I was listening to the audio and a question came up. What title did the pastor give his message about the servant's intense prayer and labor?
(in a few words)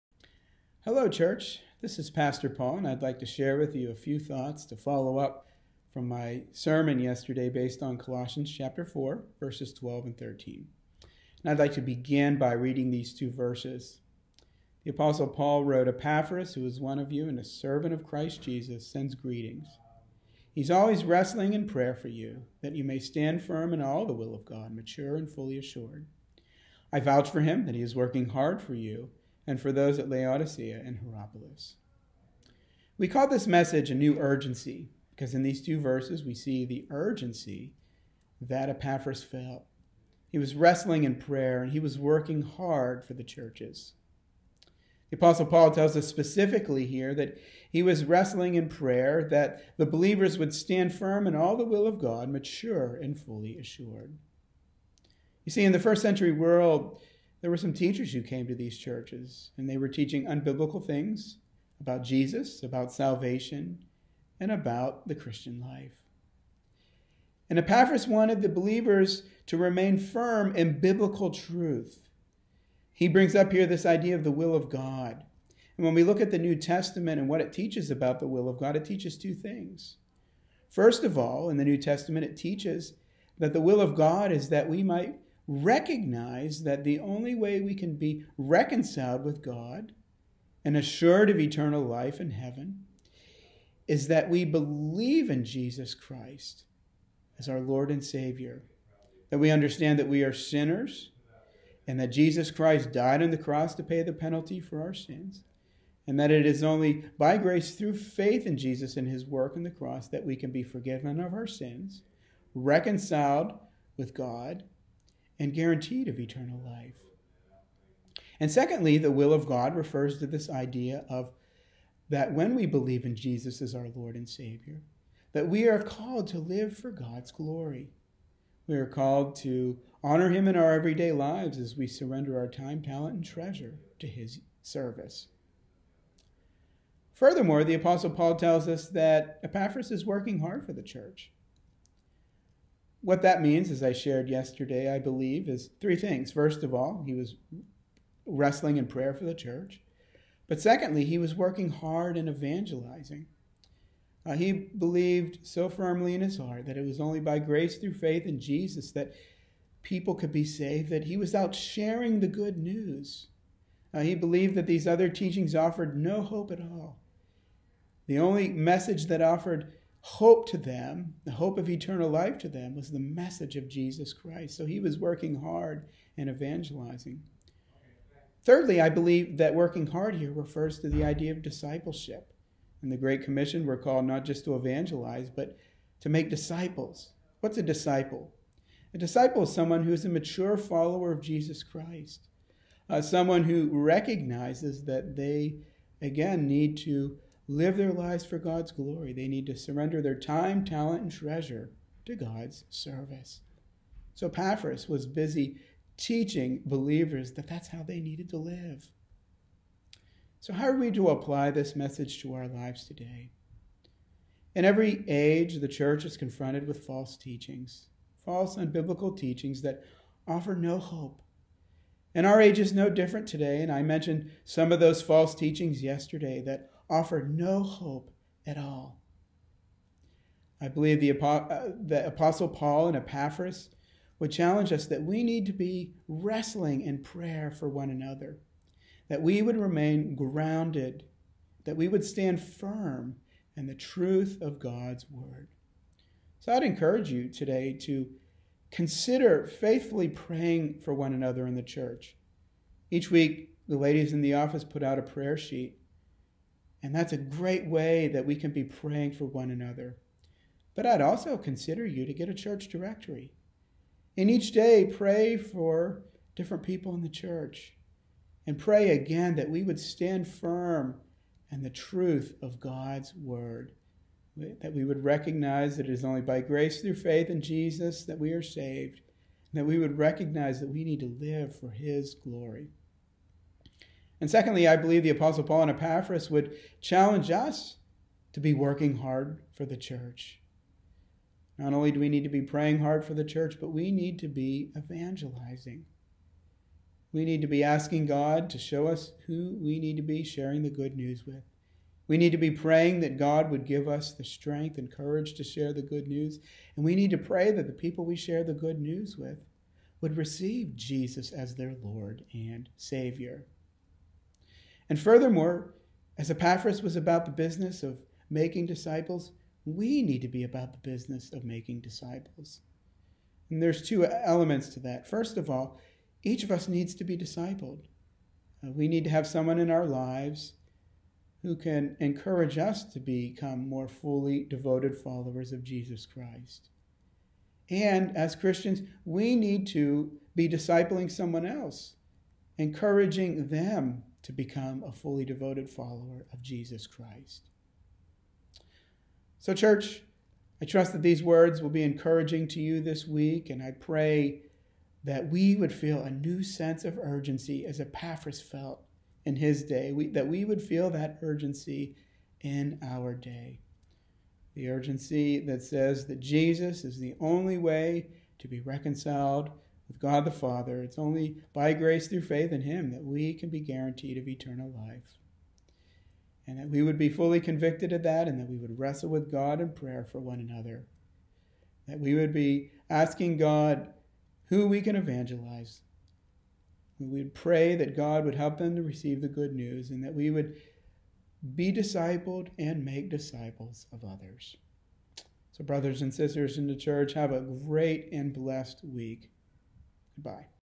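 A New Urgency.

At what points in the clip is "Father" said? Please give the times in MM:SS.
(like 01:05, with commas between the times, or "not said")
06:10.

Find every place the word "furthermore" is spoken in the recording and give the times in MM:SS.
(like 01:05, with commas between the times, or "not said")
02:17, 05:14.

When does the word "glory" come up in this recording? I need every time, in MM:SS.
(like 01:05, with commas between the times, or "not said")
02:07, 03:18, 04:42.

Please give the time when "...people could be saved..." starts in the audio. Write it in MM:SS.
02:39.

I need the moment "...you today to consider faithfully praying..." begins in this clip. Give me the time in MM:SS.
04:07.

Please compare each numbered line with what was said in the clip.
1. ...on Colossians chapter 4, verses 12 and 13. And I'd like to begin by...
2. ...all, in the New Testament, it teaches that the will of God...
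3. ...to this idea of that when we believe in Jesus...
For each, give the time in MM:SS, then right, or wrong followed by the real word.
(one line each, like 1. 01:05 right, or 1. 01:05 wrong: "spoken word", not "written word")
1. 00:07 right
2. 01:21 right
3. 02:00 right.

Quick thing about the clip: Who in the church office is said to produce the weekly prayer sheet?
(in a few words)
The ladies in the office.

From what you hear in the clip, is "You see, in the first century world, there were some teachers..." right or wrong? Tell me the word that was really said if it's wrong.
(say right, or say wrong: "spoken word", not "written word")
right.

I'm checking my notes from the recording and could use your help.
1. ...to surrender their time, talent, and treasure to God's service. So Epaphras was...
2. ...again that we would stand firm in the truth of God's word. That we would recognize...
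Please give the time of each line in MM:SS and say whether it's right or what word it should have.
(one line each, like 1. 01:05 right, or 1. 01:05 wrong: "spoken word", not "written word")
1. 03:19 right
2. 04:28 right.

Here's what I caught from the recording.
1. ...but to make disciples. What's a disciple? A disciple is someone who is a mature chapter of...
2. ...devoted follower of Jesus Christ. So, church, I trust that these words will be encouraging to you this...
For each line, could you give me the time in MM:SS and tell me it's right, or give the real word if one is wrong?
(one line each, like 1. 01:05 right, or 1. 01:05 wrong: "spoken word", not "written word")
1. 03:05 wrong: "follower", not "chapter"
2. 05:45 right.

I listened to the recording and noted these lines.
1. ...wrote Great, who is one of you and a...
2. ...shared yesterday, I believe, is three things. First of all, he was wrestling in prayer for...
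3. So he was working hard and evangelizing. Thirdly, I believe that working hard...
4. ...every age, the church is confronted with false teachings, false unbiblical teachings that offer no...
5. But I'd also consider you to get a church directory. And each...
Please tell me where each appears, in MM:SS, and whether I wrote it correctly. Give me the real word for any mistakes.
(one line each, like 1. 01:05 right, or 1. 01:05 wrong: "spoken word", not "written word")
1. 00:15 wrong: "Epaphras", not "Great"
2. 02:23 right
3. 02:54 right
4. 03:34 right
5. 04:20 right.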